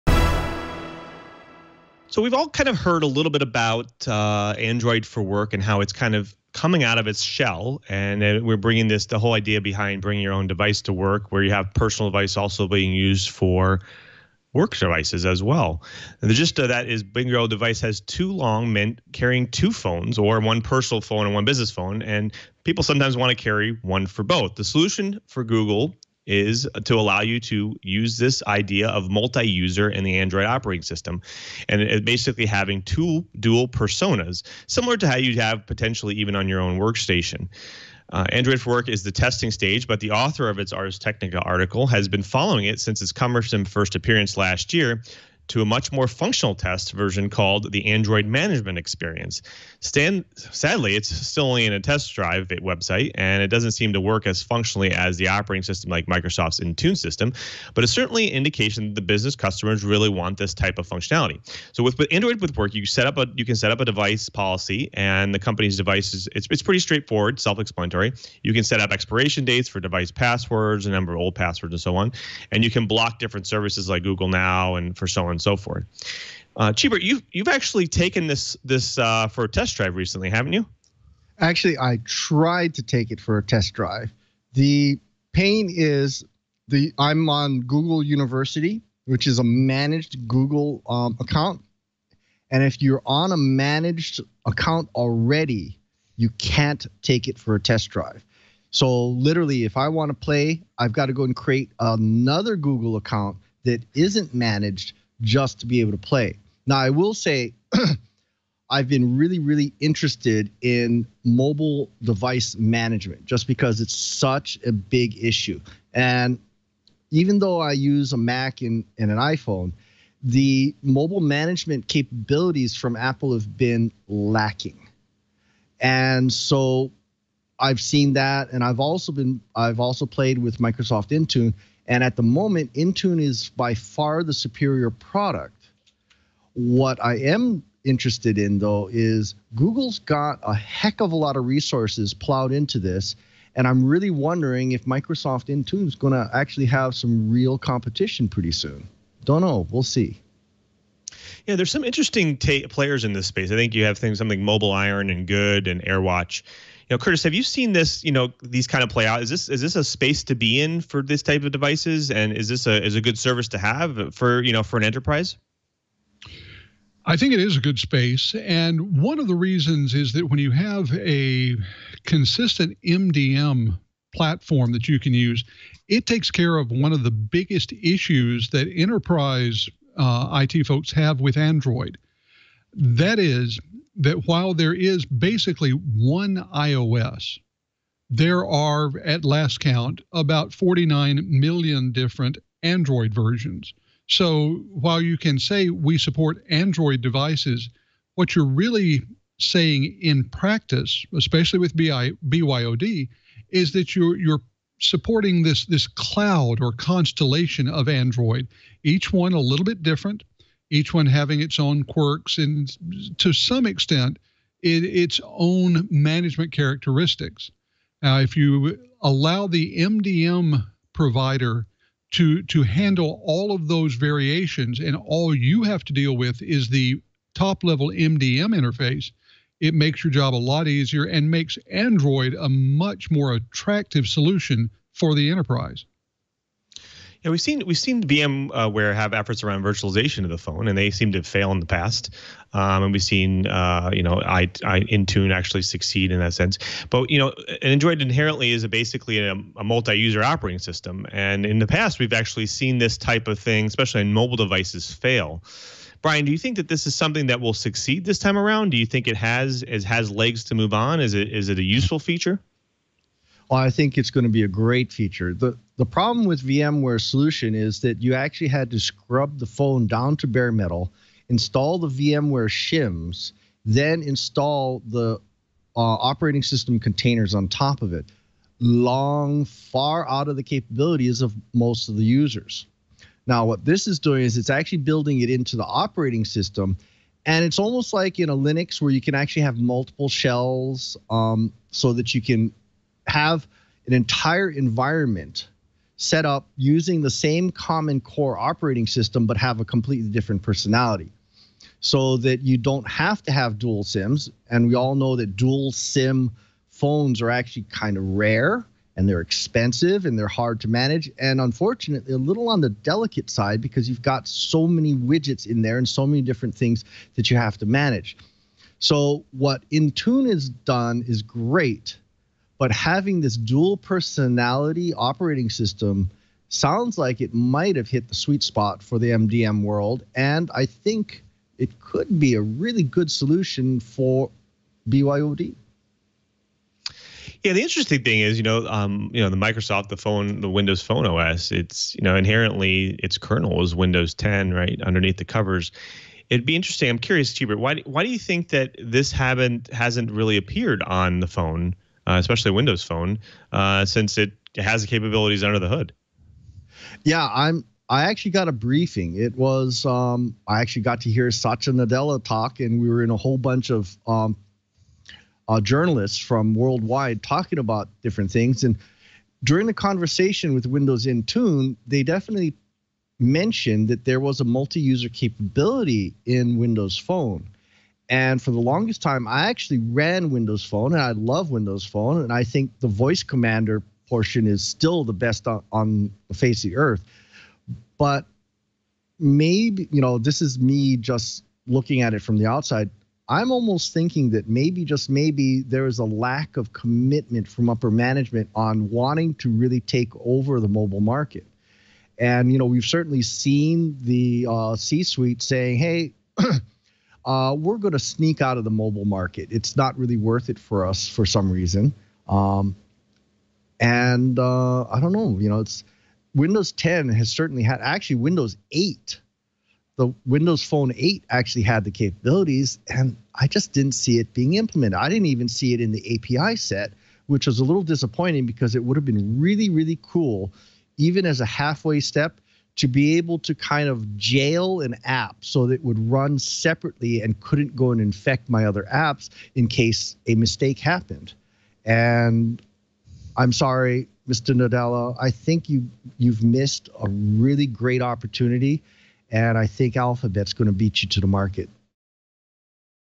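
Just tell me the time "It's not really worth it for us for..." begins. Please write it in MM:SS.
06:49.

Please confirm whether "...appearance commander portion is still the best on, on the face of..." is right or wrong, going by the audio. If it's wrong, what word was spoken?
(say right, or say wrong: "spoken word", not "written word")
wrong: "voice", not "appearance".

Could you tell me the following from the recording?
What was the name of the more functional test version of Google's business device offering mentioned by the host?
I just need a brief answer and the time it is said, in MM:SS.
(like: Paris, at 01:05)
Android Management Experience, at 00:47.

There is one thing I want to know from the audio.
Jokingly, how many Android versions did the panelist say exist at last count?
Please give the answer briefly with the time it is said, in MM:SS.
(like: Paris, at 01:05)
49 million, at 03:10.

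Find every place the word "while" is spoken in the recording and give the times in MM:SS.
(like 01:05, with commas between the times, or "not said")
03:04, 03:14.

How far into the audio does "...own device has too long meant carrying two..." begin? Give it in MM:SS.
00:17.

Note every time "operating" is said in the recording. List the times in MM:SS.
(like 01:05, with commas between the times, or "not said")
00:30, 00:55, 04:10, 04:35, 04:45, 04:58, 05:24.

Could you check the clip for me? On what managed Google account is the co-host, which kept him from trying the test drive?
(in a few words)
Google University.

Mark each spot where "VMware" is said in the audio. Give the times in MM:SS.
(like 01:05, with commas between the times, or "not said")
03:58, 04:26, 04:31.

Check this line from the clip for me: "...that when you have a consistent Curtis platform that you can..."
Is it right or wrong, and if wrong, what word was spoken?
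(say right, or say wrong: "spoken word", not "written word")
wrong: "MDM", not "Curtis".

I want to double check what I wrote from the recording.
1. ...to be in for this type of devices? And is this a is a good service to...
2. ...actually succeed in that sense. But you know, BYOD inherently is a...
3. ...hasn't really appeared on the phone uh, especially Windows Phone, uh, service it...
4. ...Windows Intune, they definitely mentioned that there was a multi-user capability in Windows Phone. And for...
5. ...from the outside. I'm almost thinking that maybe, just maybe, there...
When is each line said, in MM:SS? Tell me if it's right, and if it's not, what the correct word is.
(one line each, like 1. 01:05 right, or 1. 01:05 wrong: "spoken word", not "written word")
1. 02:40 right
2. 04:05 wrong: "Android", not "BYOD"
3. 05:49 wrong: "since", not "service"
4. 06:10 right
5. 06:32 right.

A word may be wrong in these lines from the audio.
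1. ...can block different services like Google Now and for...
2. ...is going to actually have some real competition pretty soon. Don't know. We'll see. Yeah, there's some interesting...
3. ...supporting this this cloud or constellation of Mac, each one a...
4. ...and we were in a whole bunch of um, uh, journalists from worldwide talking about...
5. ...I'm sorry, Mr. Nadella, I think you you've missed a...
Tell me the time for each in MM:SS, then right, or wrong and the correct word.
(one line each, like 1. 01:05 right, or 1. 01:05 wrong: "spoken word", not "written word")
1. 01:12 right
2. 02:25 right
3. 03:24 wrong: "Android", not "Mac"
4. 06:02 right
5. 07:23 right.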